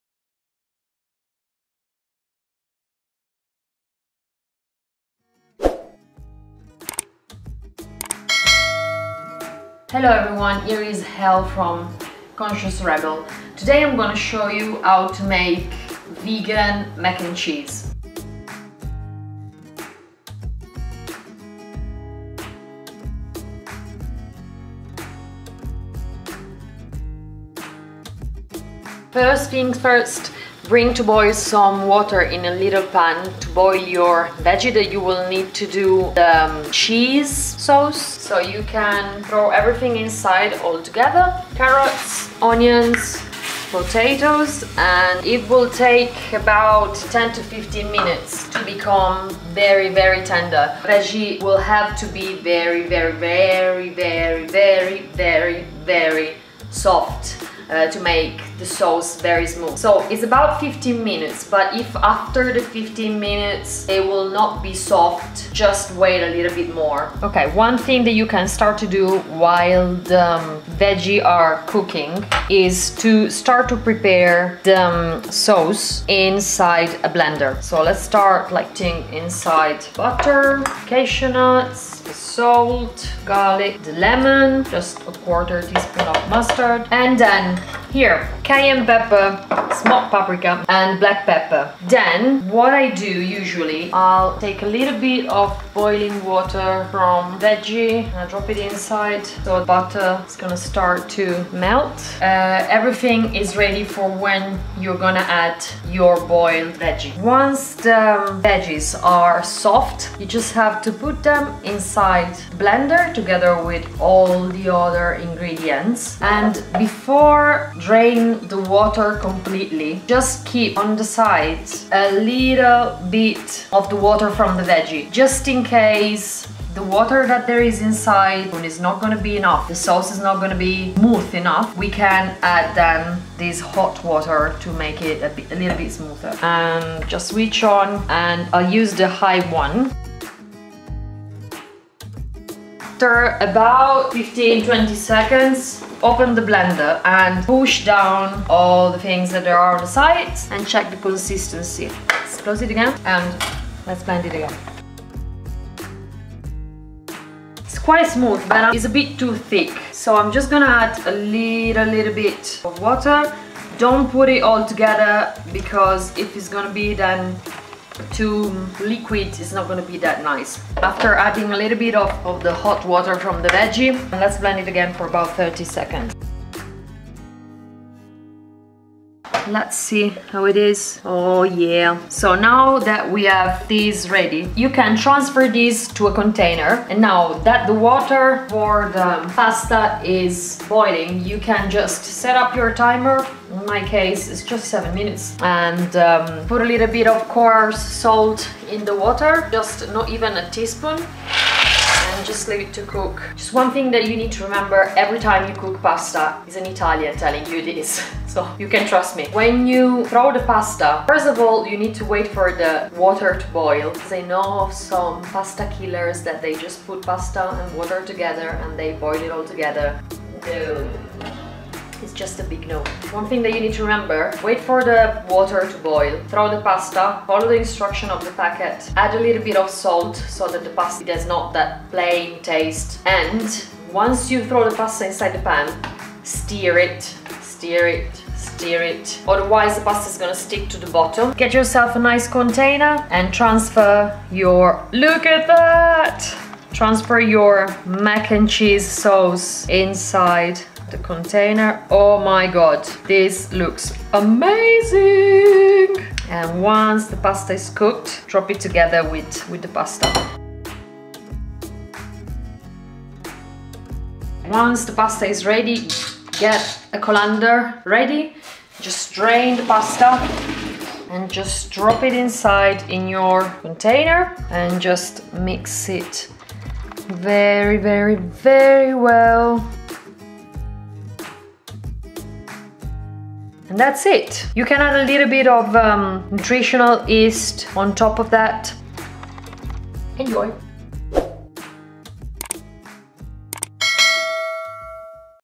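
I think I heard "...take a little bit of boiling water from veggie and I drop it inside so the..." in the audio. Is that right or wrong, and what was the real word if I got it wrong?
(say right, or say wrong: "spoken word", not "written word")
right.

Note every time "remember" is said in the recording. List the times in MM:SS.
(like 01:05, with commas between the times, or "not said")
03:24, 03:43.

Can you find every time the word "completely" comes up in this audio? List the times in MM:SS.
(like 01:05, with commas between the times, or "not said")
01:59.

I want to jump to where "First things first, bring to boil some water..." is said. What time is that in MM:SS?
00:29.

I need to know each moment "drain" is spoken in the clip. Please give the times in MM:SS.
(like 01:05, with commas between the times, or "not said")
01:57, 04:29.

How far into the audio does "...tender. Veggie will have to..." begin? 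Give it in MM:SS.
00:50.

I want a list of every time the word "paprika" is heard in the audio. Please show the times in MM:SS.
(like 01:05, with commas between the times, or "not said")
01:30.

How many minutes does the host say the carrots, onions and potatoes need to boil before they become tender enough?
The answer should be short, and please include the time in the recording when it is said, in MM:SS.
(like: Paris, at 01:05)
10 to 15, at 00:46.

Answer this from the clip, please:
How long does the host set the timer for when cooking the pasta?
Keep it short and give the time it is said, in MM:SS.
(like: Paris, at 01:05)
7 minutes, at 03:14.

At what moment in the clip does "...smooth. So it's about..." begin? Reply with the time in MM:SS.
00:59.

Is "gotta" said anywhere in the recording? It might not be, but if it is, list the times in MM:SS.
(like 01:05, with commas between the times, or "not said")
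not said.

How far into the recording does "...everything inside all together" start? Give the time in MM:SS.
00:39.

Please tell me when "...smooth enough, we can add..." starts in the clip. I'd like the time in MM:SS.
02:10.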